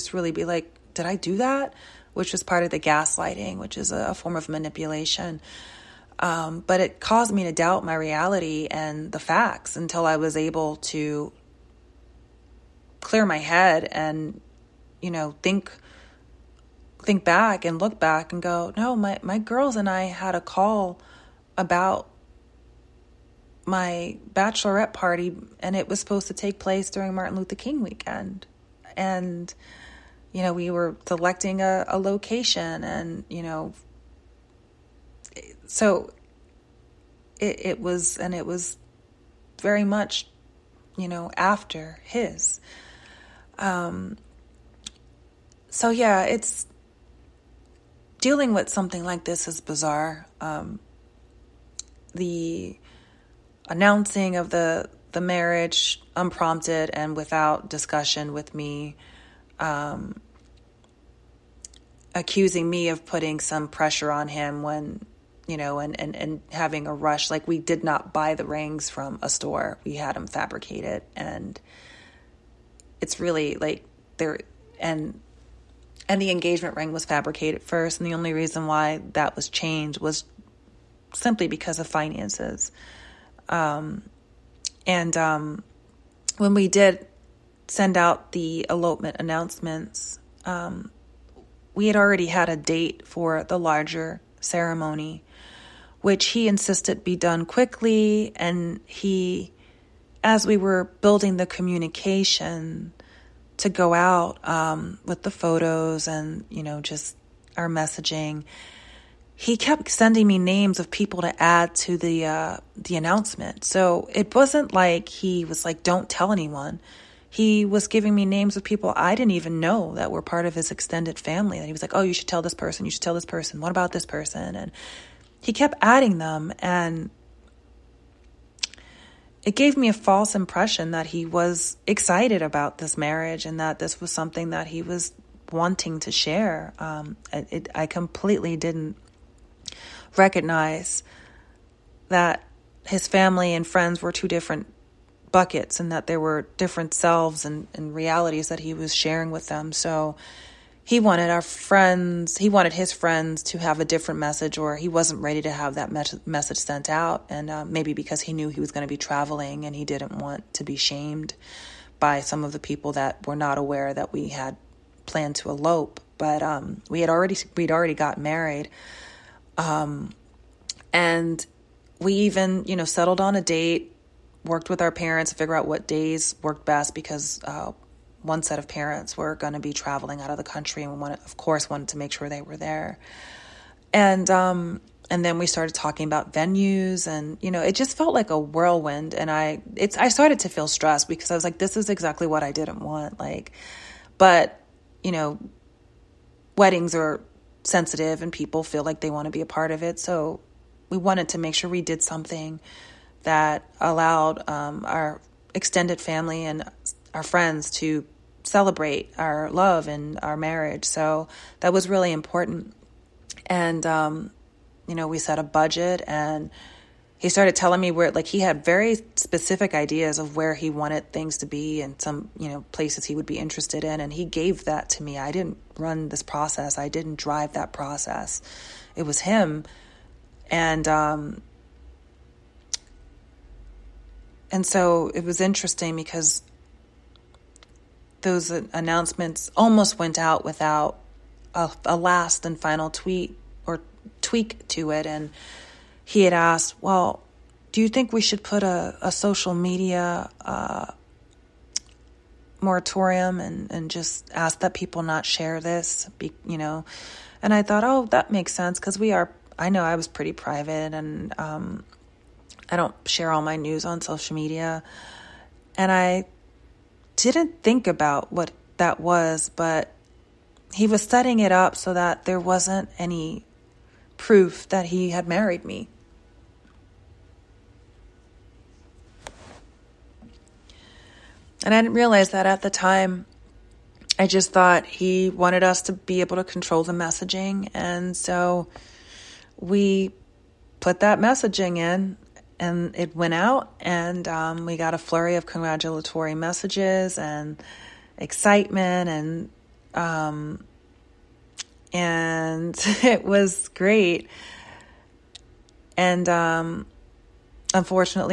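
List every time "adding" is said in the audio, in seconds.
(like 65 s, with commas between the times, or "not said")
125 s.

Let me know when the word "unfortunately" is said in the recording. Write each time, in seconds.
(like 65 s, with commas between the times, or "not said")
307 s.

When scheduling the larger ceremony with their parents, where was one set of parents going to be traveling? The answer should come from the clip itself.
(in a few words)
out of the country.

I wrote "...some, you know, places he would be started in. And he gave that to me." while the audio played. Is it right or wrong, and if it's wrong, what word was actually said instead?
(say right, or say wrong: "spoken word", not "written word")
wrong: "interested", not "started".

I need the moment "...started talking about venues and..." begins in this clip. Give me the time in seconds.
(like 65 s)
185 s.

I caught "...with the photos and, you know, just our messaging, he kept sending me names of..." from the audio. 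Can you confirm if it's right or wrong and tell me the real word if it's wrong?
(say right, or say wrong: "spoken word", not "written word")
right.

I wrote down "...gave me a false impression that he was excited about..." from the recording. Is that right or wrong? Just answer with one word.
right.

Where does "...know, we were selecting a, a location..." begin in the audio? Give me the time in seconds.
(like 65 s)
30 s.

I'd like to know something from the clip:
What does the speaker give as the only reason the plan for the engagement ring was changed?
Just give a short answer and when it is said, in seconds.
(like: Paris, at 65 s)
finances, at 81 s.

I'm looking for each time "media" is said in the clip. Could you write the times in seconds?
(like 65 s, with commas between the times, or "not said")
249 s, 264 s.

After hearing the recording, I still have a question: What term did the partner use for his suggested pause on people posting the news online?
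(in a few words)
moratorium.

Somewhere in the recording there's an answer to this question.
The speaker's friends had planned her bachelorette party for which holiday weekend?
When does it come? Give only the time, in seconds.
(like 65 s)
27 s.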